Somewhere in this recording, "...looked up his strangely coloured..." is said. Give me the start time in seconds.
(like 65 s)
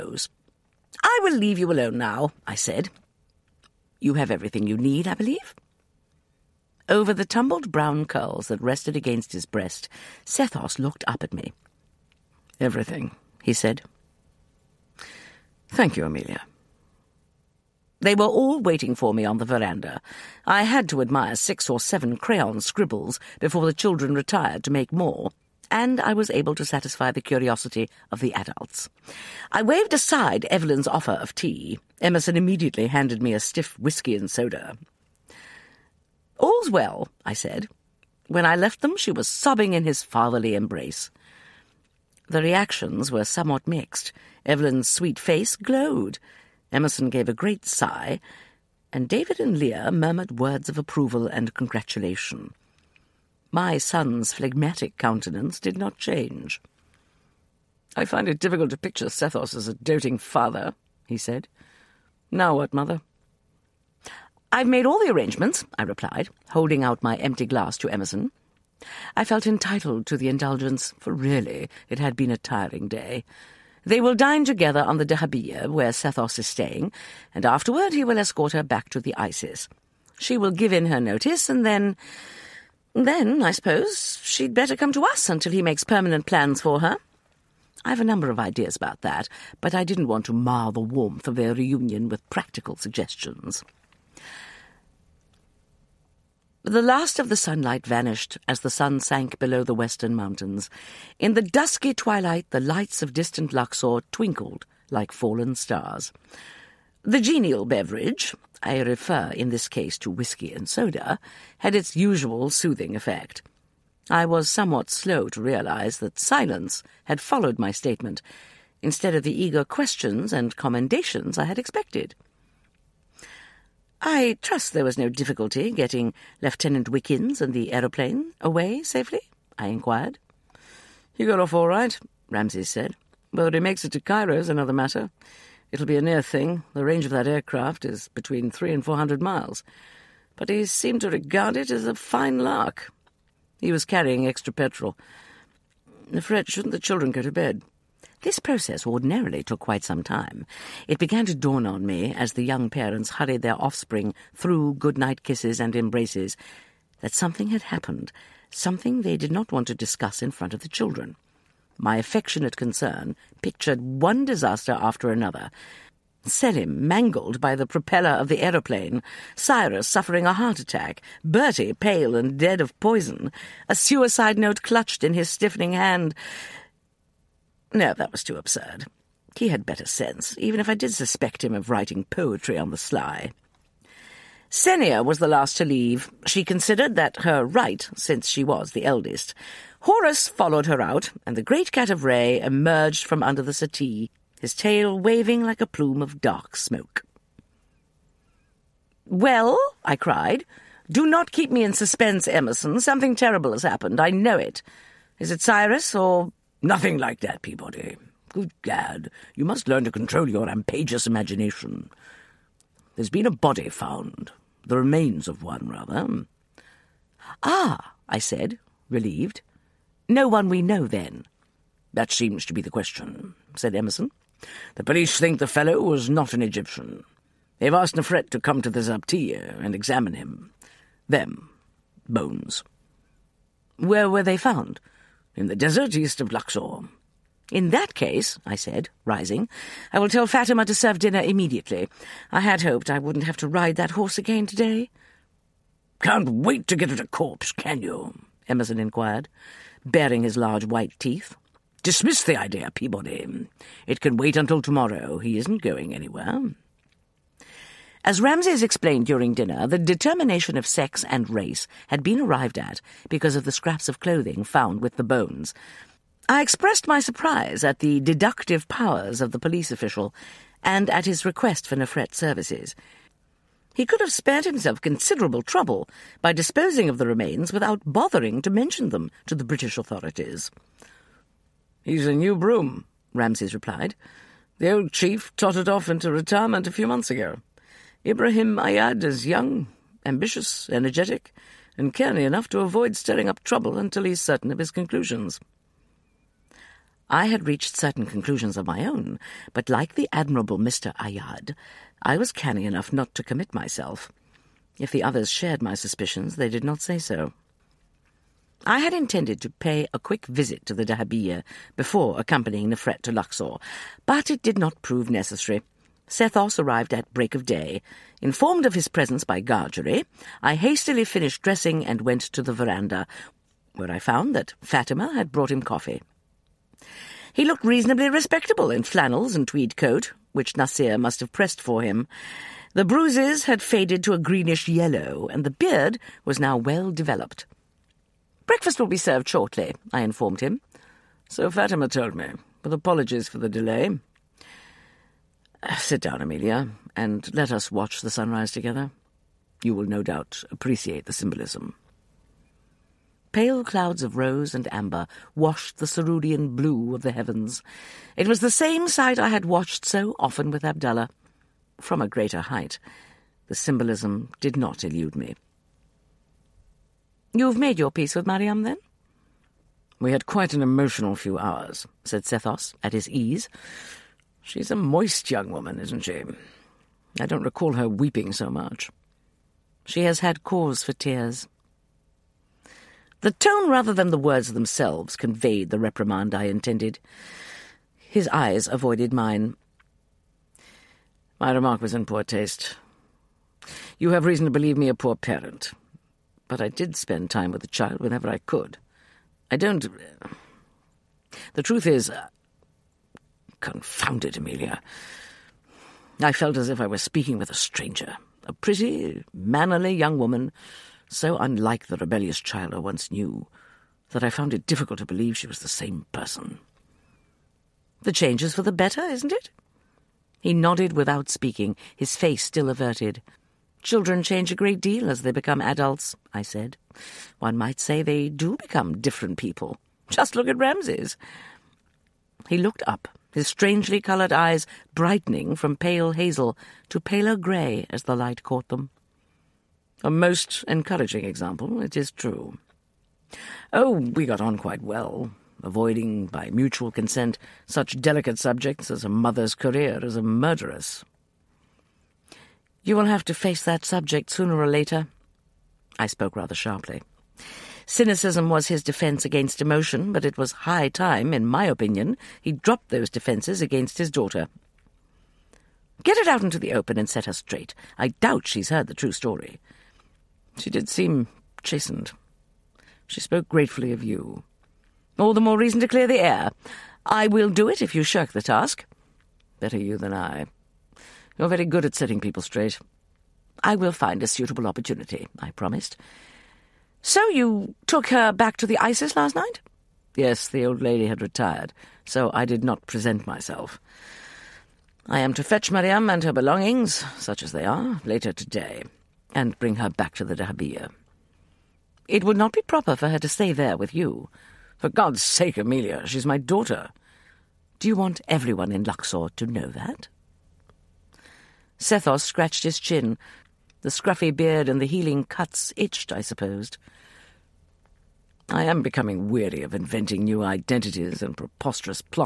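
432 s.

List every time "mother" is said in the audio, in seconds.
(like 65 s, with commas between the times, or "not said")
62 s, 449 s.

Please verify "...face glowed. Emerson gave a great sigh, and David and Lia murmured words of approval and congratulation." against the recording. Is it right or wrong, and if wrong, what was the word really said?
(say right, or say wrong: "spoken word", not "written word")
right.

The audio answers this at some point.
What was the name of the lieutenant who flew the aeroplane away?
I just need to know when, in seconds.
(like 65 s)
126 s.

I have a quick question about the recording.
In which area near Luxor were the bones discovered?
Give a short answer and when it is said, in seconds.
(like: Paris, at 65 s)
Desert east of Luxor, at 235 s.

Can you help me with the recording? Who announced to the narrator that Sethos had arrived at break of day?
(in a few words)
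Gargery.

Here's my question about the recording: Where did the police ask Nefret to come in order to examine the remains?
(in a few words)
The Zabtiya.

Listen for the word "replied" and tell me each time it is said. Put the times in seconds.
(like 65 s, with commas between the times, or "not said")
65 s, 283 s.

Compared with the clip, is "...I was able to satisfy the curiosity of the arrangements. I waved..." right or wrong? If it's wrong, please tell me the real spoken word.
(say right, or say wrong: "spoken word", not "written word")
wrong: "adults", not "arrangements".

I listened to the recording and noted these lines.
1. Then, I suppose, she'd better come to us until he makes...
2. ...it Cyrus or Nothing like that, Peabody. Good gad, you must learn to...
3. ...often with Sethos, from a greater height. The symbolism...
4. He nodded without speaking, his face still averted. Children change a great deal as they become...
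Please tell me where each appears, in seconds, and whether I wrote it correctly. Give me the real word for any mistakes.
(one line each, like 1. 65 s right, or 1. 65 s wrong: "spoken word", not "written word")
1. 82 s right
2. 205 s right
3. 360 s wrong: "Abdullah", not "Sethos"
4. 420 s right.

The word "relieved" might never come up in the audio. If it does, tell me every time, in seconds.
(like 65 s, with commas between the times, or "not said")
218 s.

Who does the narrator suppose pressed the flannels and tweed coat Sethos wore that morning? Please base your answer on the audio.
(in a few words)
Nasir.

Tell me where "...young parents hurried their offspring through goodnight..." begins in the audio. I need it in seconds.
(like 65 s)
152 s.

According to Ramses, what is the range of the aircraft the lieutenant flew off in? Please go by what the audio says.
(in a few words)
300 to 400 miles.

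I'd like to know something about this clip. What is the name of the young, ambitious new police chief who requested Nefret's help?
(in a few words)
Ibrahim Ayad.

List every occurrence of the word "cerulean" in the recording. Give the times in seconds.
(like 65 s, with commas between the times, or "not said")
355 s.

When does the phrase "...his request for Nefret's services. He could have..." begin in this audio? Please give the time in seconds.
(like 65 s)
271 s.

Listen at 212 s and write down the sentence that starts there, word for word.
There's been a body found, the remains of one, rather.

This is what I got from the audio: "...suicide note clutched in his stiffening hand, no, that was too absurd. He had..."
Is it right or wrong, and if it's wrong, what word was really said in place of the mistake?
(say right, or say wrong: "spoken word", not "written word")
right.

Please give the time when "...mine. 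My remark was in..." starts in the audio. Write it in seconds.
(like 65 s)
389 s.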